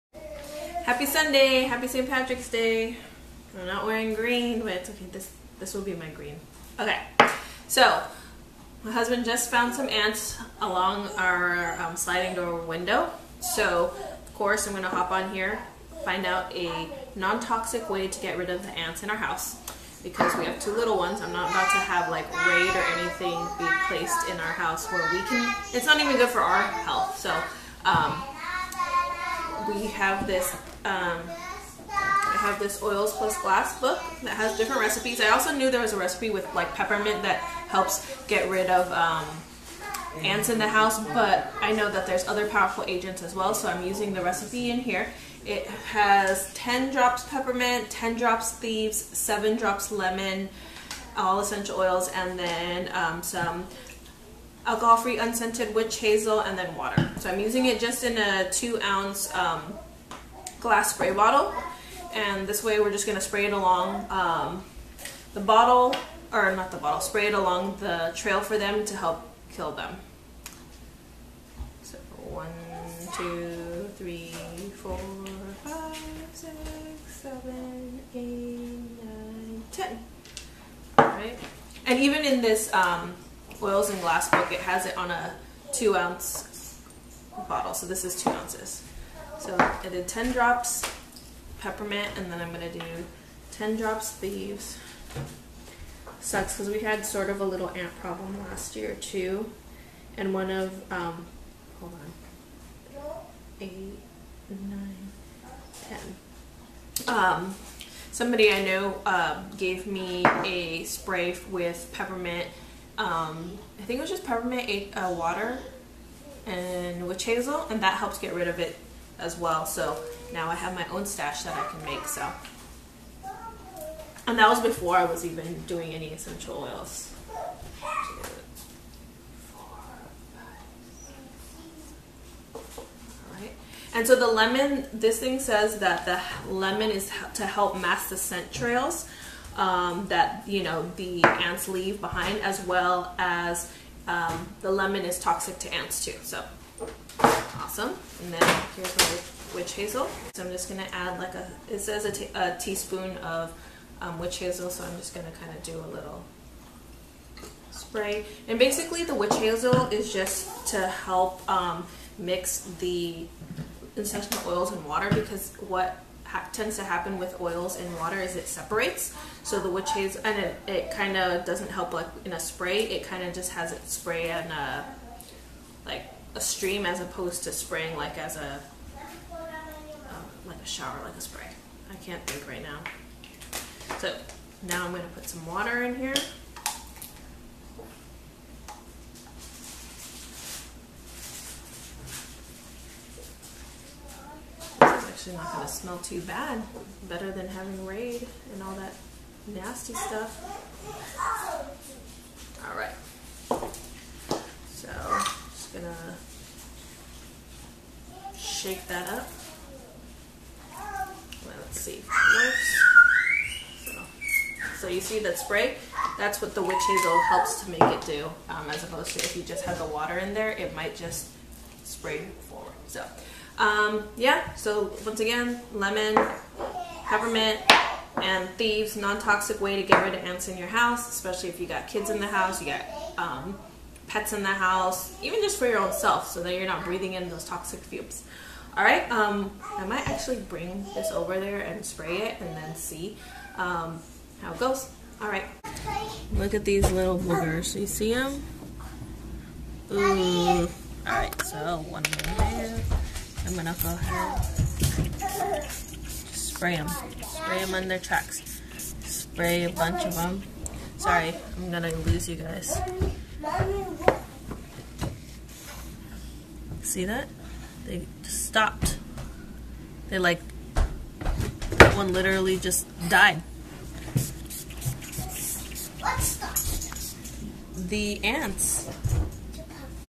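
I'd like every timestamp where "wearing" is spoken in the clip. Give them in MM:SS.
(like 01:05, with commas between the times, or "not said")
00:03.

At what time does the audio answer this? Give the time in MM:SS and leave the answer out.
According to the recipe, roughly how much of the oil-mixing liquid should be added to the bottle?
02:32.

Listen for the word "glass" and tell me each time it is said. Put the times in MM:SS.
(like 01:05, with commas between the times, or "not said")
00:33, 01:00, 01:24.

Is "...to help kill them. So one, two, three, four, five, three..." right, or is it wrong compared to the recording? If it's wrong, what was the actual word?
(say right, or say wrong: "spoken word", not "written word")
wrong: "six", not "three".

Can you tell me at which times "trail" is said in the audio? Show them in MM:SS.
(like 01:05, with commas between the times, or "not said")
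01:08, 02:18.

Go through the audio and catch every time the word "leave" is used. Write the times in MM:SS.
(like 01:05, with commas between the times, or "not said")
02:21.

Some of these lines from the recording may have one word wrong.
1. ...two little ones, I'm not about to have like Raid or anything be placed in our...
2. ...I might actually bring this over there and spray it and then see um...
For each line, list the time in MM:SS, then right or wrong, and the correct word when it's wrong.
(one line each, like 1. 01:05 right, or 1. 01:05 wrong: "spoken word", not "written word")
1. 00:20 right
2. 03:59 right.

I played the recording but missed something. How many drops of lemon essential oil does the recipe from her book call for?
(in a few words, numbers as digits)
7.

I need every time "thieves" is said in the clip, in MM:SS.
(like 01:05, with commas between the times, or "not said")
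00:48, 01:34, 03:48.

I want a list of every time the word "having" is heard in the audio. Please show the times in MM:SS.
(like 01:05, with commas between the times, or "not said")
03:17.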